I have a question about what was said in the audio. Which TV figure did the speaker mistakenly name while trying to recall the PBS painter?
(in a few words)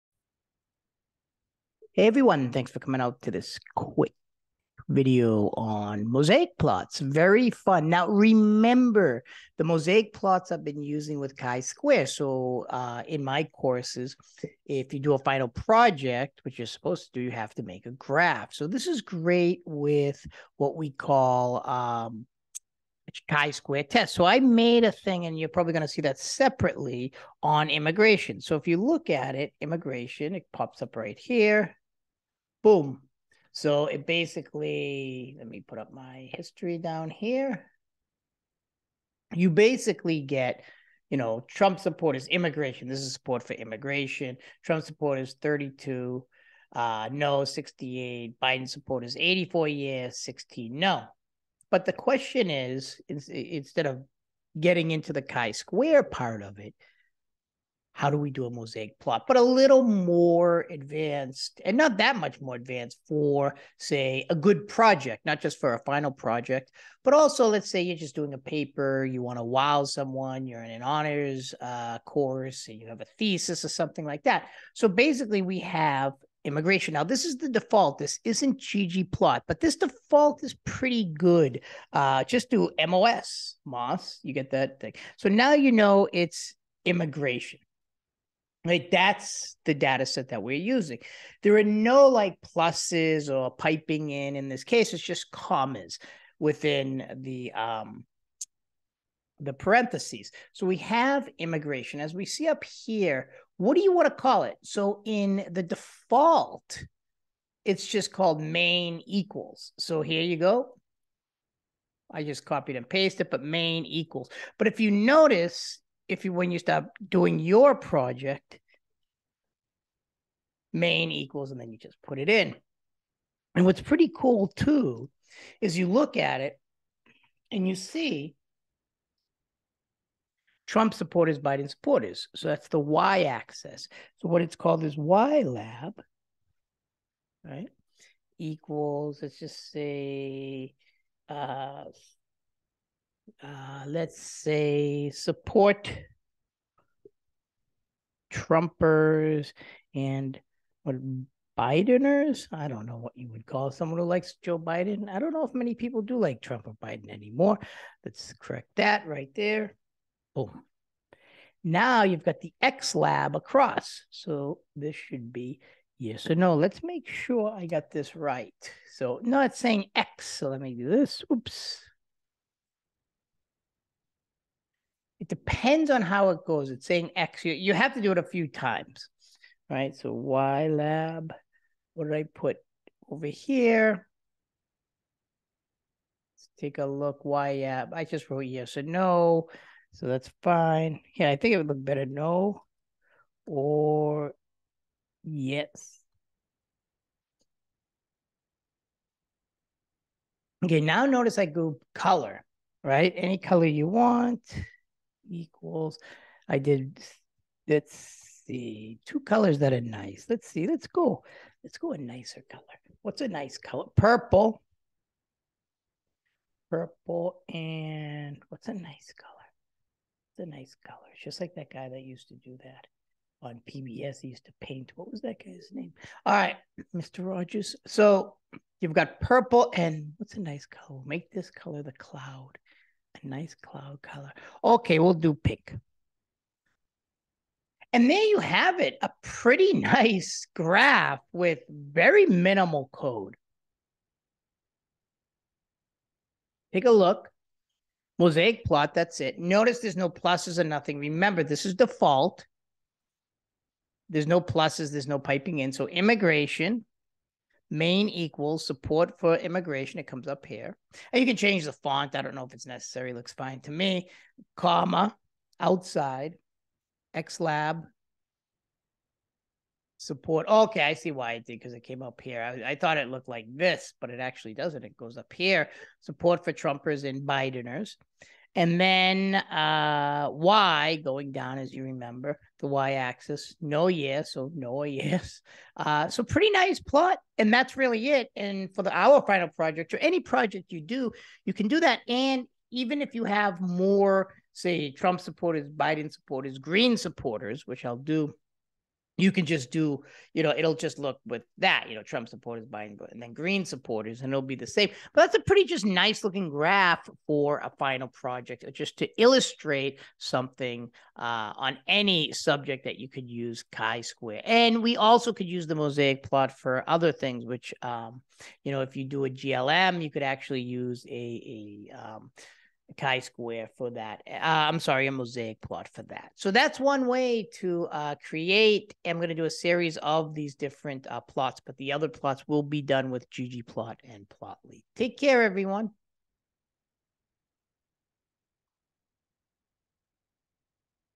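Mr. Rogers.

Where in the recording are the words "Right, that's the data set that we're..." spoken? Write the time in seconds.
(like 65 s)
88 s.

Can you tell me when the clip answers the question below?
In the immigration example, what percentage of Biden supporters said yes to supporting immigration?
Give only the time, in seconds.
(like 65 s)
49 s.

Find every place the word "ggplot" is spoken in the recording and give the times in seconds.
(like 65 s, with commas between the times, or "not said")
78 s, 333 s.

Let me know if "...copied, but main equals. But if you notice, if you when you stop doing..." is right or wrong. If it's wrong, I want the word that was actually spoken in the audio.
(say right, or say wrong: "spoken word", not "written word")
wrong: "pasted", not "copied".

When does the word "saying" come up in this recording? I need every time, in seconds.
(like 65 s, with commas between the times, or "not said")
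169 s, 176 s.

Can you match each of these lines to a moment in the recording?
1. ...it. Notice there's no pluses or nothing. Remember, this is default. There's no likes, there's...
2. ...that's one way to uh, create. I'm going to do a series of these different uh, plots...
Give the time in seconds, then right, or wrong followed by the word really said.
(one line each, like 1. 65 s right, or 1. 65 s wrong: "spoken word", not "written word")
1. 249 s wrong: "pluses", not "likes"
2. 326 s right.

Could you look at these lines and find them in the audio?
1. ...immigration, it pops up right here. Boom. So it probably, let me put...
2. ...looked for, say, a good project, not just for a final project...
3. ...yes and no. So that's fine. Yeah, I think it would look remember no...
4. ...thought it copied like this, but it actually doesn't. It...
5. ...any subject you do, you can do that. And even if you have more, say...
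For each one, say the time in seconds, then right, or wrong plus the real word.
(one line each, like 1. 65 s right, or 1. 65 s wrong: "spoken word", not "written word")
1. 29 s wrong: "basically", not "probably"
2. 62 s wrong: "advanced", not "looked"
3. 188 s wrong: "better", not "remember"
4. 272 s wrong: "looked", not "copied"
5. 289 s wrong: "project", not "subject".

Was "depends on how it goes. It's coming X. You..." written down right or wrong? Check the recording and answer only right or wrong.
wrong.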